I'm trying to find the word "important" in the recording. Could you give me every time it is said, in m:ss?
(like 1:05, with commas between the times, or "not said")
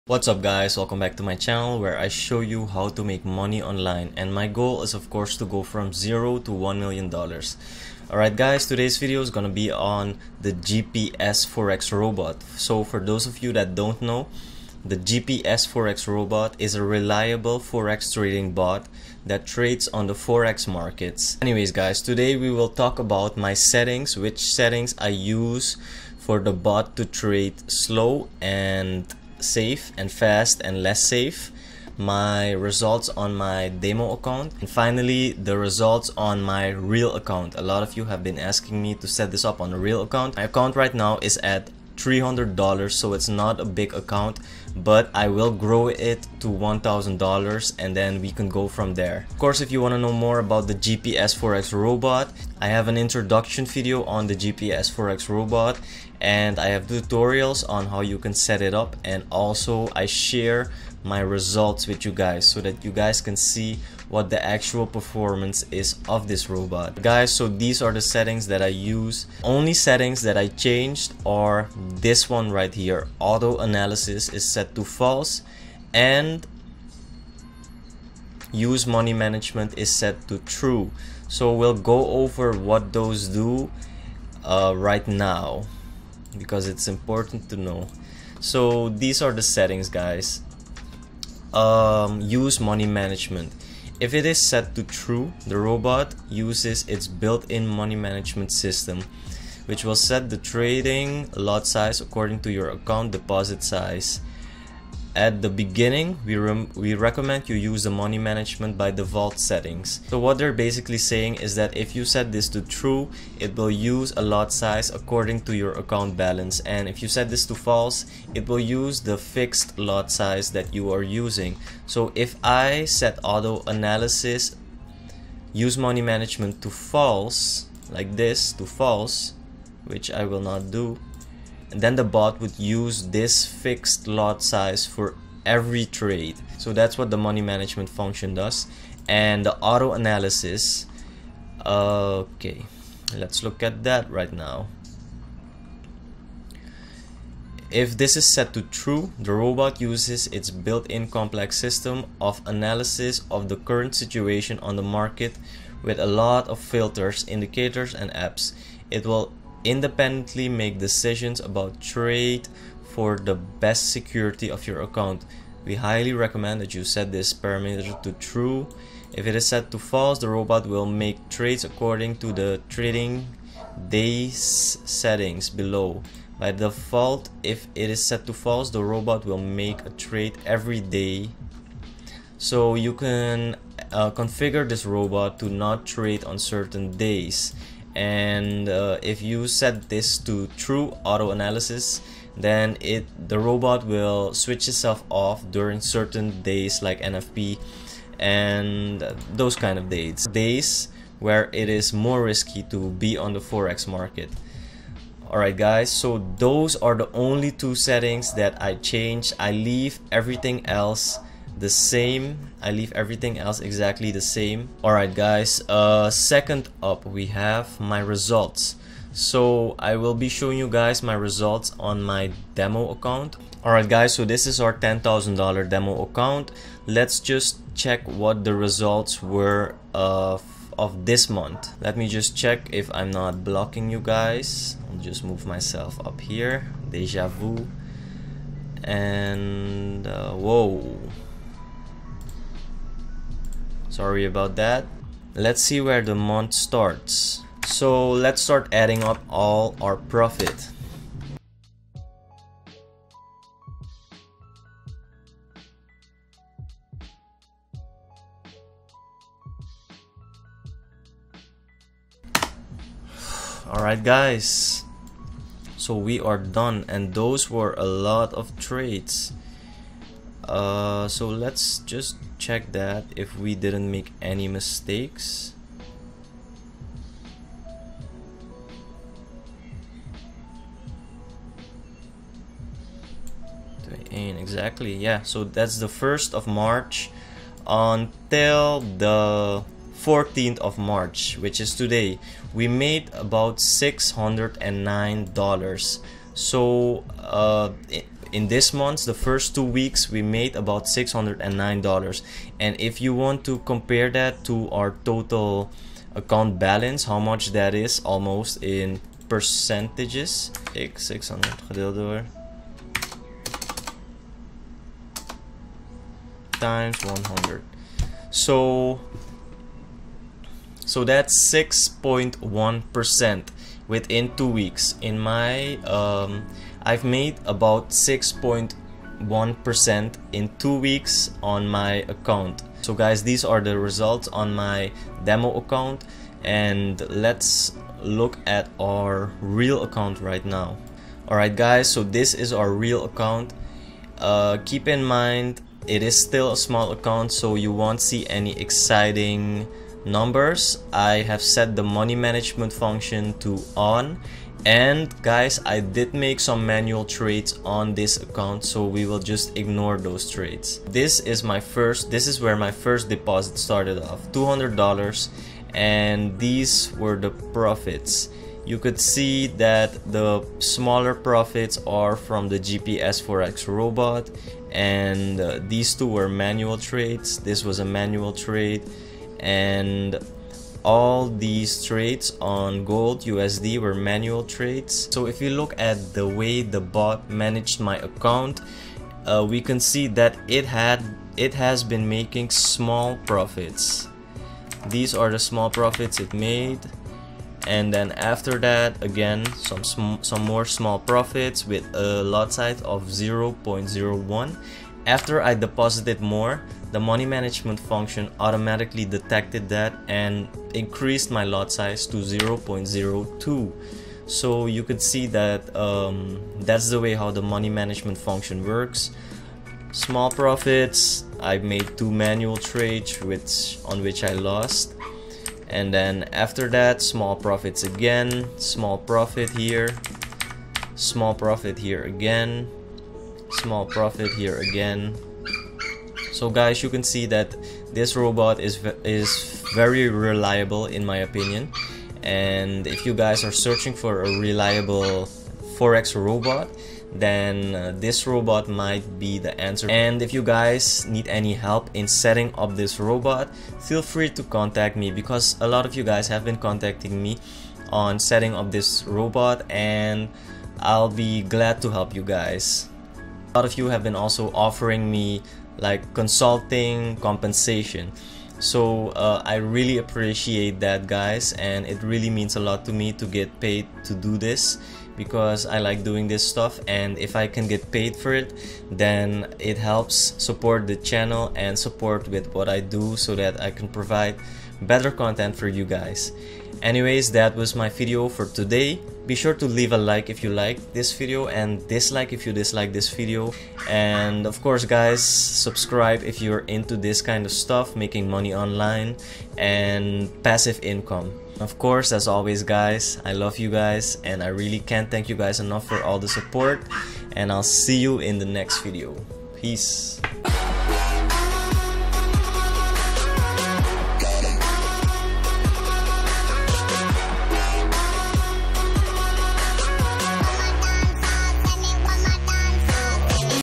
1:26.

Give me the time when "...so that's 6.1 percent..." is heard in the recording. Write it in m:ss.
5:20.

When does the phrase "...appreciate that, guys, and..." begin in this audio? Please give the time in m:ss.
7:49.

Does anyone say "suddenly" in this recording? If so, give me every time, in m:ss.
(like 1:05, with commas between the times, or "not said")
not said.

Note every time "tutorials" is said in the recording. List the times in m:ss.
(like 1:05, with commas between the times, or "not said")
0:56.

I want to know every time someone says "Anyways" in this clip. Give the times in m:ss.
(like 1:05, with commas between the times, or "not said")
0:21, 8:06.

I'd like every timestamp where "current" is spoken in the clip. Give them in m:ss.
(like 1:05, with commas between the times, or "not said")
2:33.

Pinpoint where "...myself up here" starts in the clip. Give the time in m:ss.
3:55.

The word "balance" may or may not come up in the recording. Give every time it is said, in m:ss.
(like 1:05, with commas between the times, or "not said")
1:56, 5:06.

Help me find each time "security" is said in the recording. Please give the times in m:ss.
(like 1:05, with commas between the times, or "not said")
2:43.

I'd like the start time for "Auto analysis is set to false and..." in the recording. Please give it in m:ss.
1:13.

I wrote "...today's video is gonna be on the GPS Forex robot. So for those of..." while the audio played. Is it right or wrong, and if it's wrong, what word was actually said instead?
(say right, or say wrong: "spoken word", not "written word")
right.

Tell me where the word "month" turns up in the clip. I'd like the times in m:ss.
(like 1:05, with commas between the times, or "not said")
3:51, 4:06, 4:58.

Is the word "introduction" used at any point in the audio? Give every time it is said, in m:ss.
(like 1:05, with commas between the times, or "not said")
0:52.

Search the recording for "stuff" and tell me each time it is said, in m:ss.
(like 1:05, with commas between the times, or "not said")
7:56, 8:17.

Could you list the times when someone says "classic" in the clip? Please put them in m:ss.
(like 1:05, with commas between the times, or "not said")
not said.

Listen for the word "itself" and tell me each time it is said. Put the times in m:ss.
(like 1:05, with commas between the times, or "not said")
3:14.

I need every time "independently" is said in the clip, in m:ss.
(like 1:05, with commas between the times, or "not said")
2:39.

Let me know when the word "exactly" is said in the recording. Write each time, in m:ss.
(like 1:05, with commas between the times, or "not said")
3:33, 4:44.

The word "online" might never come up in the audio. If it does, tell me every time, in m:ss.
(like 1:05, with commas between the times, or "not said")
0:03, 8:18.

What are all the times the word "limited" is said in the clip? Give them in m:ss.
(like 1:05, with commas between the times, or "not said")
not said.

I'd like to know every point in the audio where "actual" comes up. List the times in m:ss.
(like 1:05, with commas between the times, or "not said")
1:04.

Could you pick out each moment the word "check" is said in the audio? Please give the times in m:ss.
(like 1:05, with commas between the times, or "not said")
3:47, 3:52, 4:32.